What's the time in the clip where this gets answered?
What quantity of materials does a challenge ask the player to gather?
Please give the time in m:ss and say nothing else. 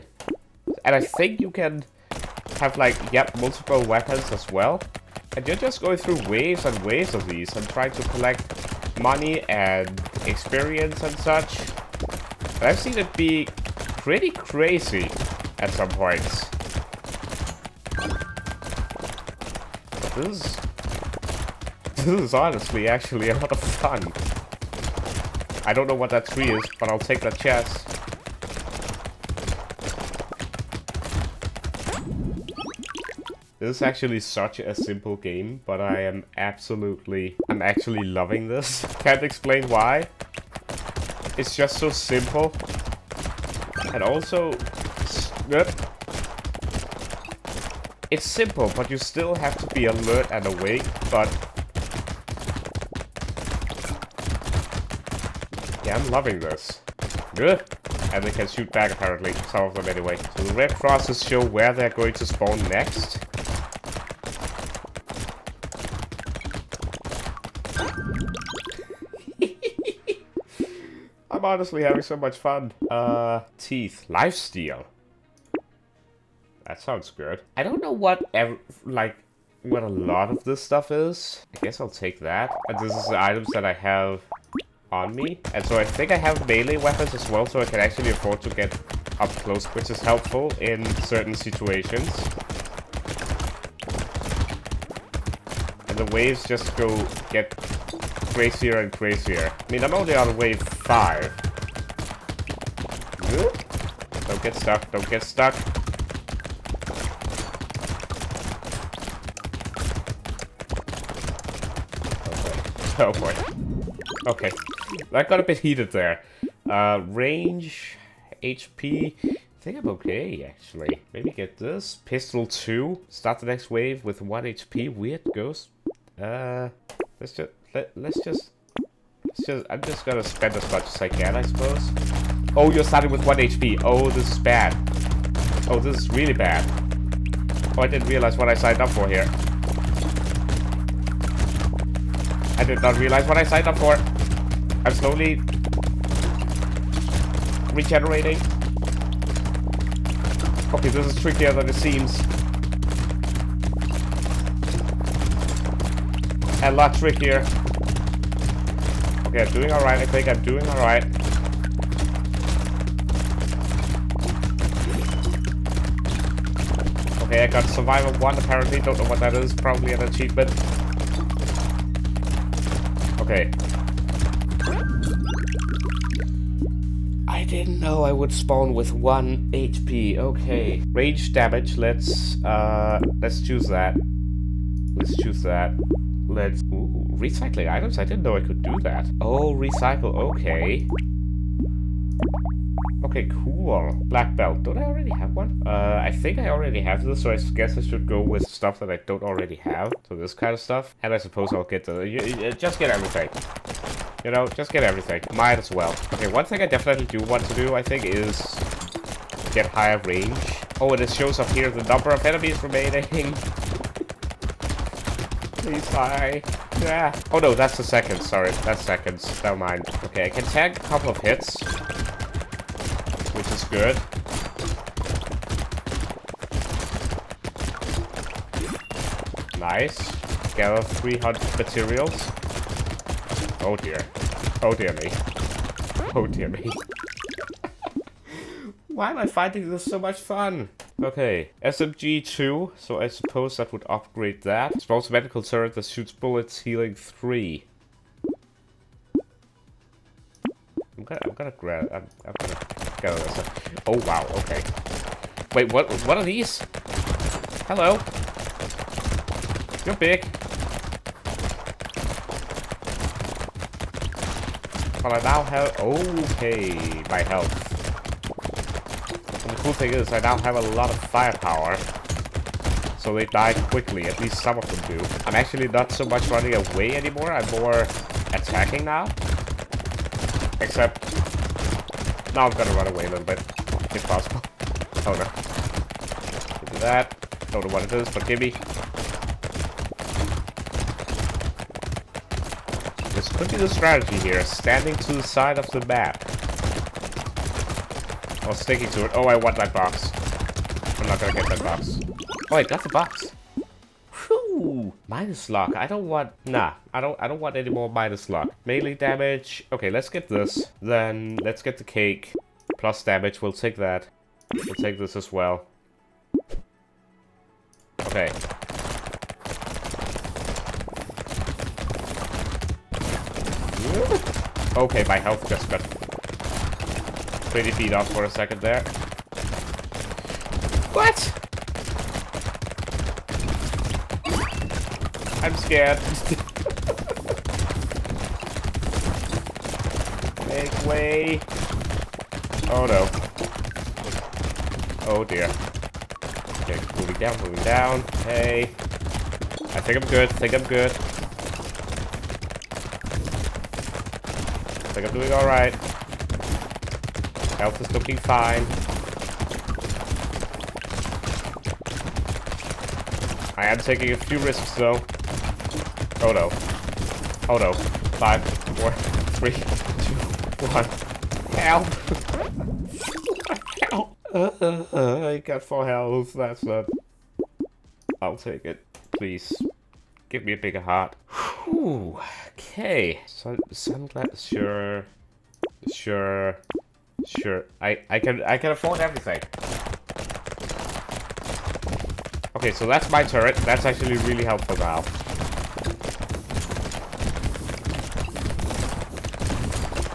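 3:50.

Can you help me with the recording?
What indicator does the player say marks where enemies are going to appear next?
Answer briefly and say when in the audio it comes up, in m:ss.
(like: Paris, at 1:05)
Red crosses, at 1:00.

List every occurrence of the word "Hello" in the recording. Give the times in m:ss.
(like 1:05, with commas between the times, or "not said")
4:17.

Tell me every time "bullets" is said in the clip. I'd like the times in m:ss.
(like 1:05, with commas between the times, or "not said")
4:06.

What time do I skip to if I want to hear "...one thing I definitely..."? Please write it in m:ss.
3:26.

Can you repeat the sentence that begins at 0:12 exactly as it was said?
And I've seen it be pretty crazy at some points.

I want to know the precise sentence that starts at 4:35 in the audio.
I'm actually not so much running away anymore, I'm more attacking now.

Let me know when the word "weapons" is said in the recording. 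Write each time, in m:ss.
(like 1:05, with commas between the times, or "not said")
0:03, 1:26.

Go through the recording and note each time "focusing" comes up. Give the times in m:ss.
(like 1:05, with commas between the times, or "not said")
not said.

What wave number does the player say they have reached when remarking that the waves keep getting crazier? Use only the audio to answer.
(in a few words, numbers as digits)
5.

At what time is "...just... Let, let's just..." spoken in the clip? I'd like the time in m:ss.
2:07.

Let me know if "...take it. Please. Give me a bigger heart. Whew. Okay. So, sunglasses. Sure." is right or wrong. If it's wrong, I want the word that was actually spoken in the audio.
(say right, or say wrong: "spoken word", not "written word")
right.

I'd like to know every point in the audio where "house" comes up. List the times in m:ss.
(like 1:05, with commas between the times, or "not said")
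not said.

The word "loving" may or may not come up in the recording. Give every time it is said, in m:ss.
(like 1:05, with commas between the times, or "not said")
0:38, 0:56.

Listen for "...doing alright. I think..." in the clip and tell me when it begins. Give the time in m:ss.
2:39.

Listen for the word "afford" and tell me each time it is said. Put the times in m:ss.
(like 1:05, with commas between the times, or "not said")
1:28, 6:28.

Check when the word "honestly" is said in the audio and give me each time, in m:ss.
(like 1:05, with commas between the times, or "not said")
0:22, 1:11.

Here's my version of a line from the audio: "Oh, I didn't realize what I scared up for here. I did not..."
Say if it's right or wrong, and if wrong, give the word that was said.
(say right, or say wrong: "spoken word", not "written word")
wrong: "signed", not "scared".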